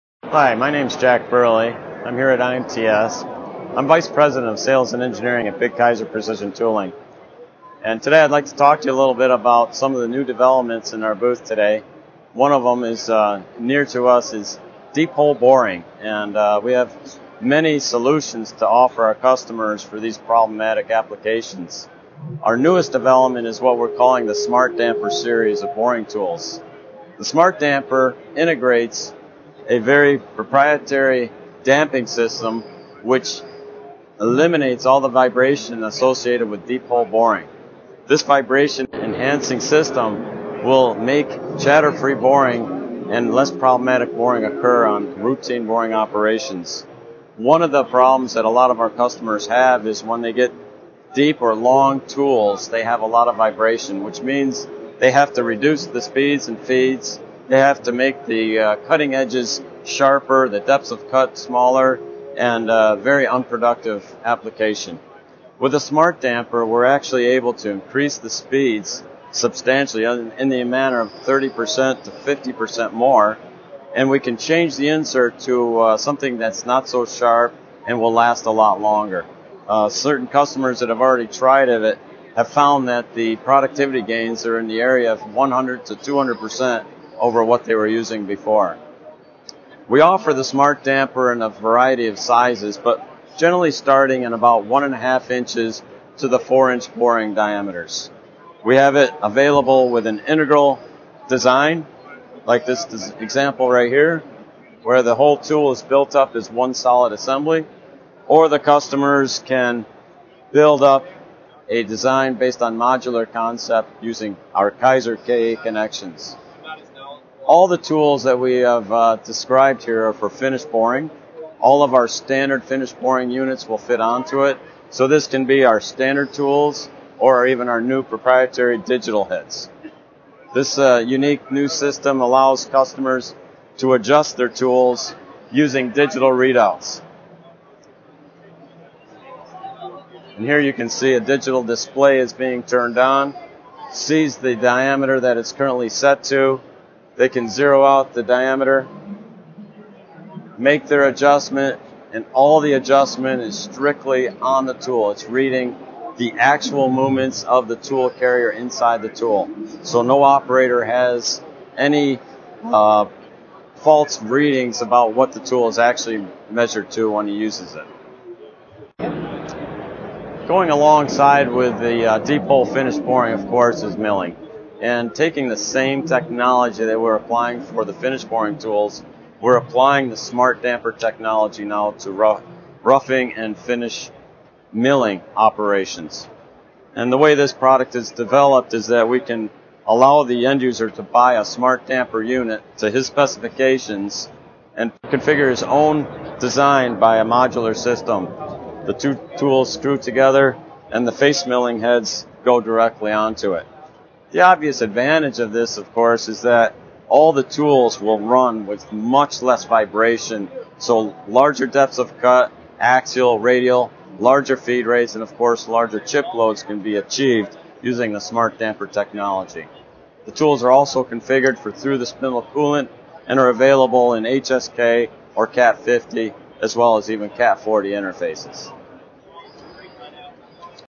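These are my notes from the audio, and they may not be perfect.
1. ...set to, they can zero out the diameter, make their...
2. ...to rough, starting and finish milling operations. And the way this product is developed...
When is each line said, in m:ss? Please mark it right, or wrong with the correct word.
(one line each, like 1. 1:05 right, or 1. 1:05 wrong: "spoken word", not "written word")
1. 2:25 right
2. 3:01 wrong: "roughing", not "starting".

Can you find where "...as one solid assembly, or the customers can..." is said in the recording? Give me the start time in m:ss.
1:46.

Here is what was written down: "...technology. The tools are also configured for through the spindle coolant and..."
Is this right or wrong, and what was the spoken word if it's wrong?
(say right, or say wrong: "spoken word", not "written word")
right.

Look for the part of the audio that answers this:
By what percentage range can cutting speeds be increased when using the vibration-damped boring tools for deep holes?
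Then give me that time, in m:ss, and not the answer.
1:11.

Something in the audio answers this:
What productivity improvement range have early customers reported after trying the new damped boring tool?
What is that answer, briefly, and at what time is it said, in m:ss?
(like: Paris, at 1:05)
100 to 200 percent, at 1:25.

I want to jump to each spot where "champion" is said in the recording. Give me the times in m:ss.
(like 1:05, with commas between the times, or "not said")
not said.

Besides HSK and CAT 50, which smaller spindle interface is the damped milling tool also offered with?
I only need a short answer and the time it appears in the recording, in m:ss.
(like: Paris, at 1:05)
CAT 40, at 3:47.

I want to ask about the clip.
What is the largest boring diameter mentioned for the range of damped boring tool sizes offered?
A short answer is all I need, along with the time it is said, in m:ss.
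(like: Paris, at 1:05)
4 inches, at 1:36.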